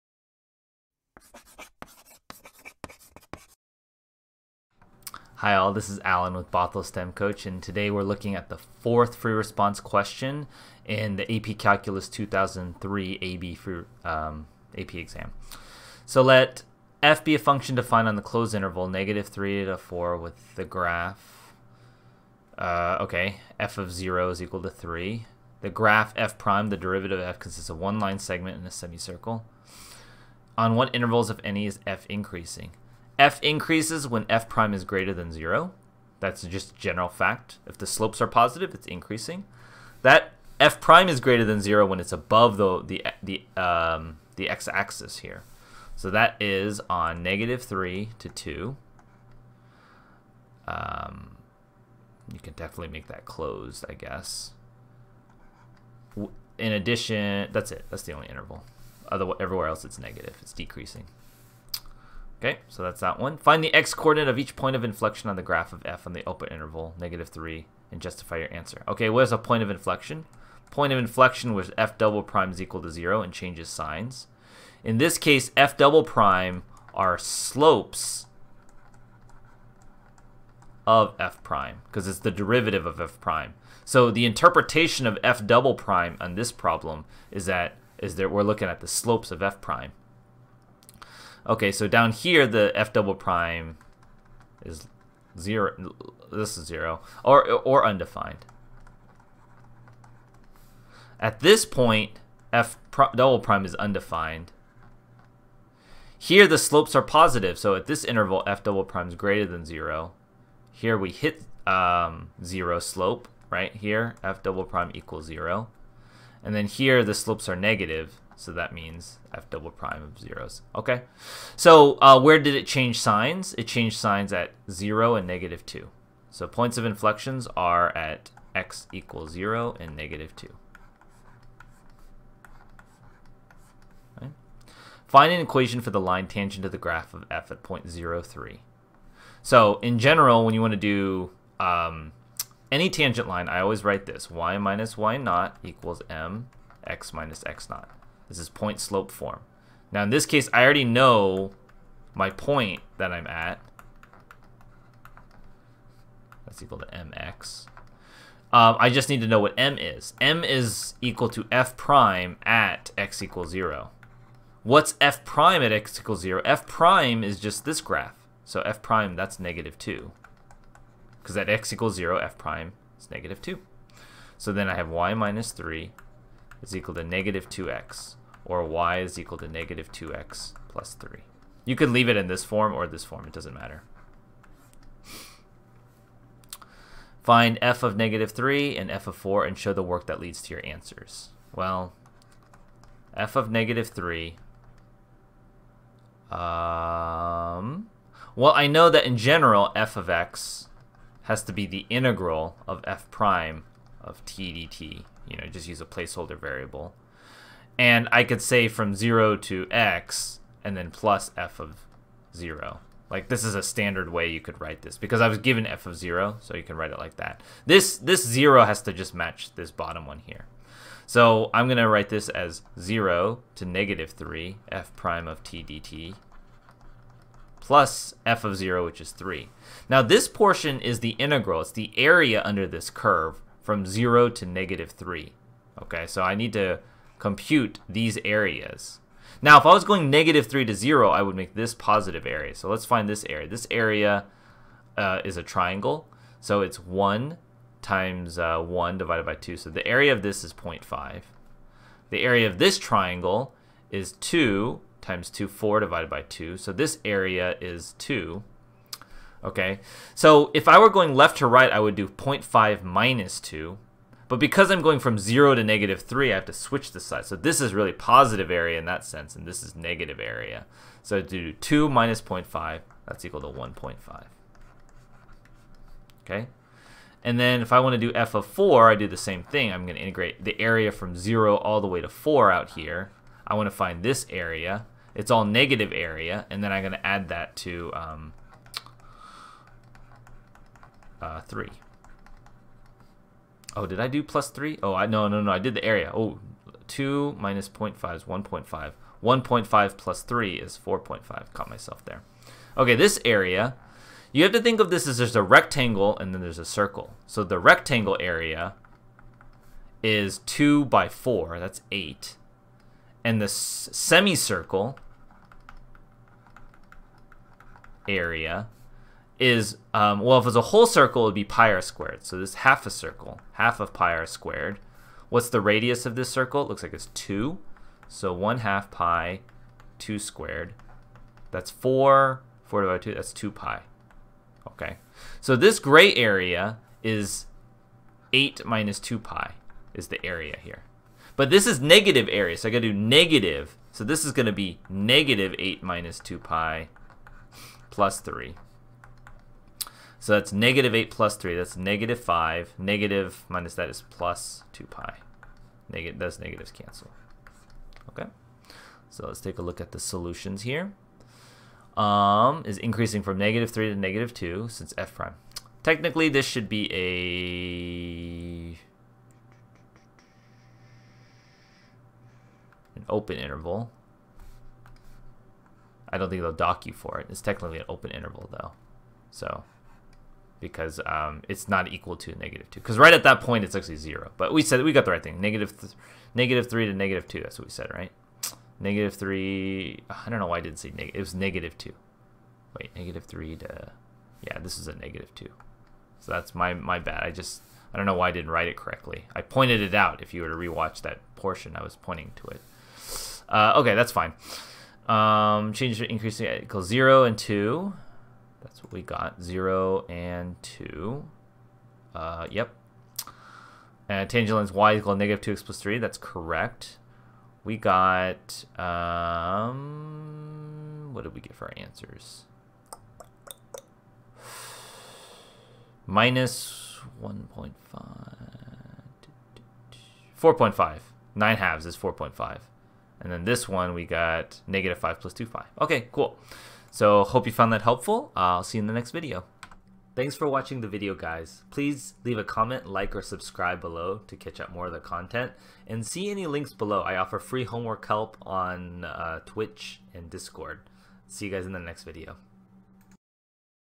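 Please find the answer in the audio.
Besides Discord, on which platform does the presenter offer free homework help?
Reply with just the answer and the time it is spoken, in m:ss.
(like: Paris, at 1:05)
Twitch, at 7:29.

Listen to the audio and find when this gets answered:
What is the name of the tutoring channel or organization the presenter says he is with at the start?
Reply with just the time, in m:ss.
0:06.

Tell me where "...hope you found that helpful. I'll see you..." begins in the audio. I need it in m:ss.
7:17.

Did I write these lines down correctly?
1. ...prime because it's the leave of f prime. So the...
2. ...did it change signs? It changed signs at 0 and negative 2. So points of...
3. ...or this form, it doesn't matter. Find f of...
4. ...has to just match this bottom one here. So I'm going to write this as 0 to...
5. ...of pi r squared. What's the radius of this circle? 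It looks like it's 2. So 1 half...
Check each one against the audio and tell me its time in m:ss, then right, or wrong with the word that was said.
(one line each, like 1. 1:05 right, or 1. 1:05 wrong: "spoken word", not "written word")
1. 1:21 wrong: "derivative", not "leave"
2. 2:02 right
3. 3:02 right
4. 3:38 right
5. 5:23 right.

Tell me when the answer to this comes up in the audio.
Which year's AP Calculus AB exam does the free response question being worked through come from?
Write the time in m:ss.
0:12.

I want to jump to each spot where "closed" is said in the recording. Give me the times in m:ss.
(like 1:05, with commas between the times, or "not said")
0:18, 0:53.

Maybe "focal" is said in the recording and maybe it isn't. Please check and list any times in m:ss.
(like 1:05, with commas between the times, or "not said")
not said.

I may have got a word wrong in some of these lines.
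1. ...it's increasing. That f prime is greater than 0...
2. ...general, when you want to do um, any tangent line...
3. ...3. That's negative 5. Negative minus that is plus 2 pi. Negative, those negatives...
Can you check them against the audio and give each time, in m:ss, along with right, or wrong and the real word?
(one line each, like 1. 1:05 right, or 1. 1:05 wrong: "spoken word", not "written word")
1. 0:38 right
2. 2:19 right
3. 5:51 right.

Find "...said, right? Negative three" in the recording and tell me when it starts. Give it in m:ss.
6:27.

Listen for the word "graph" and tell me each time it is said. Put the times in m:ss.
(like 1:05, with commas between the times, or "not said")
0:20, 0:25, 1:05, 2:16, 2:47.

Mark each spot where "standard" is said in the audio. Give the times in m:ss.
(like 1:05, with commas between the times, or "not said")
3:33.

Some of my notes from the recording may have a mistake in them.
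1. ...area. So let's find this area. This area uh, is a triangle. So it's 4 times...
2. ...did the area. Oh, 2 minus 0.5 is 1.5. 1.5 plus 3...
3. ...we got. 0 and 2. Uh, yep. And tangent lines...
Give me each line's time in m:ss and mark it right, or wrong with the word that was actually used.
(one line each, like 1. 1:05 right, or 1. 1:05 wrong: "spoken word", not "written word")
1. 4:02 wrong: "1", not "4"
2. 4:55 right
3. 6:48 right.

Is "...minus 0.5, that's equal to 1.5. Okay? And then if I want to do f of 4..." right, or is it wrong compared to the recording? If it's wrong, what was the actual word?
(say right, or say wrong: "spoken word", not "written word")
right.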